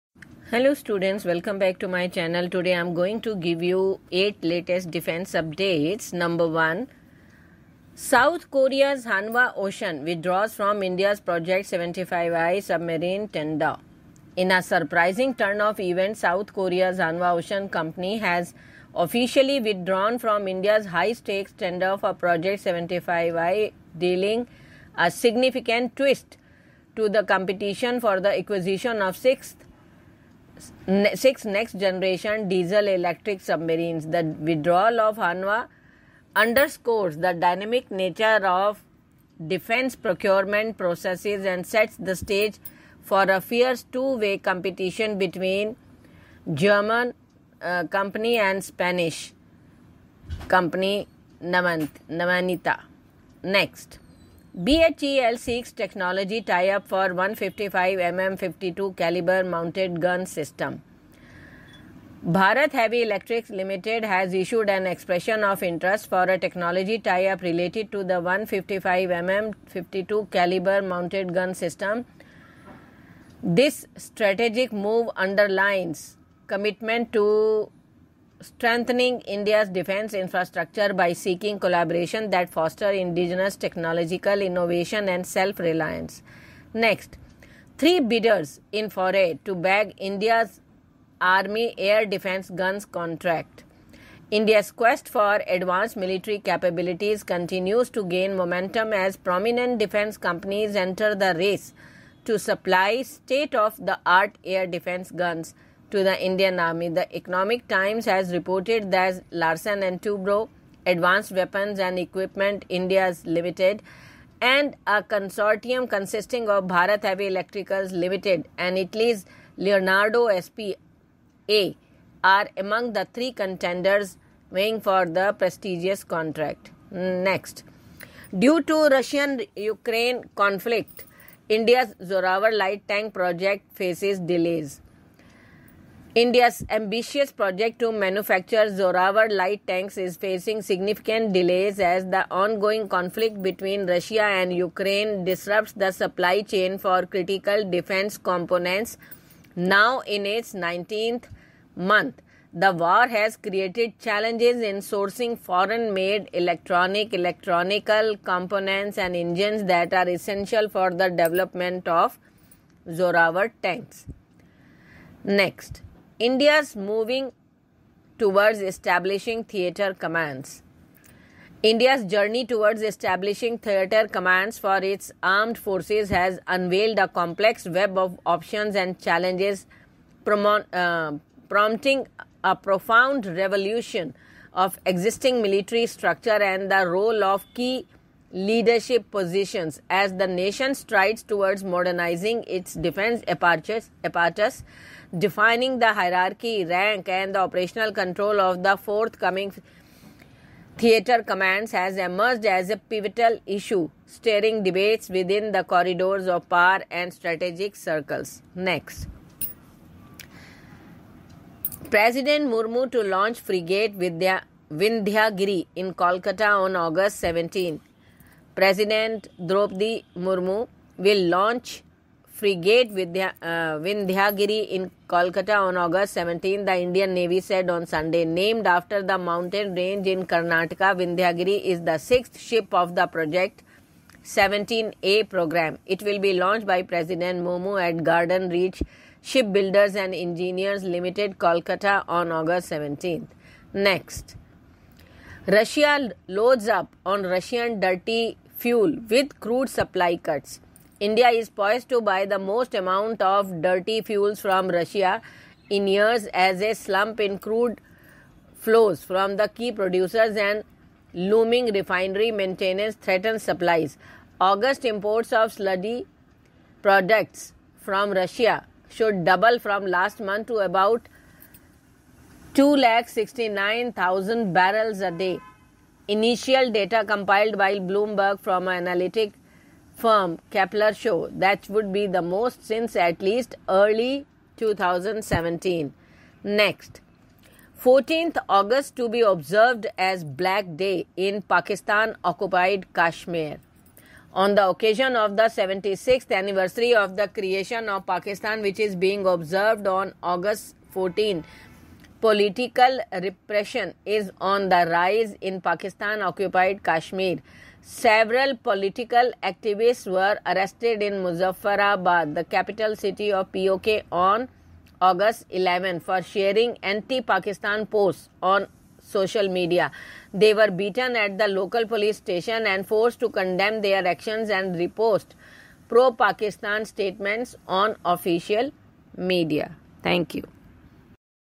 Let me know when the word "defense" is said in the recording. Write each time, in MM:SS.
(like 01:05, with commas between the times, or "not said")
00:04, 00:39, 01:19, 01:32, 01:39, 01:44, 02:27, 03:12.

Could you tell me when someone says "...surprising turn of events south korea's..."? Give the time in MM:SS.
00:14.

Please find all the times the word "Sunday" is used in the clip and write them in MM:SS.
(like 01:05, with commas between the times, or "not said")
03:47.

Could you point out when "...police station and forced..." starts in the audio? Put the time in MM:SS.
05:21.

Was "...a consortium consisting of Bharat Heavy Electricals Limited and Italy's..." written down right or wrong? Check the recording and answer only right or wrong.
right.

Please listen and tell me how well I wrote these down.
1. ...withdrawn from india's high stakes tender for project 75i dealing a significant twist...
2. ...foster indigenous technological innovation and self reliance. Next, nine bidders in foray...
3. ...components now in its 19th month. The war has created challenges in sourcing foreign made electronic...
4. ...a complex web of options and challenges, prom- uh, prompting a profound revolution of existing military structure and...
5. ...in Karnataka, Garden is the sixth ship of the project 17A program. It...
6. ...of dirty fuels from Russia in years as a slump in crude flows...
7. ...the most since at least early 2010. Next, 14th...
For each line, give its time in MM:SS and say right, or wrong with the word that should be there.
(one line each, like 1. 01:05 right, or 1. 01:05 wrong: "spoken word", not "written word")
1. 00:19 right
2. 01:22 wrong: "three", not "nine"
3. 02:28 right
4. 02:56 right
5. 03:50 wrong: "Vindhyagiri", not "Garden"
6. 04:13 right
7. 04:42 wrong: "2017", not "2010".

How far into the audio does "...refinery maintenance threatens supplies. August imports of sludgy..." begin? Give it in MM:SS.
04:21.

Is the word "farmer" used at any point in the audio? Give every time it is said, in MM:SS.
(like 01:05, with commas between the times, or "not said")
not said.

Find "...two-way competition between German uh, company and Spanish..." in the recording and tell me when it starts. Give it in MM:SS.
00:43.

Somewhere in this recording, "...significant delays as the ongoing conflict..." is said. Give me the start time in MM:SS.
02:20.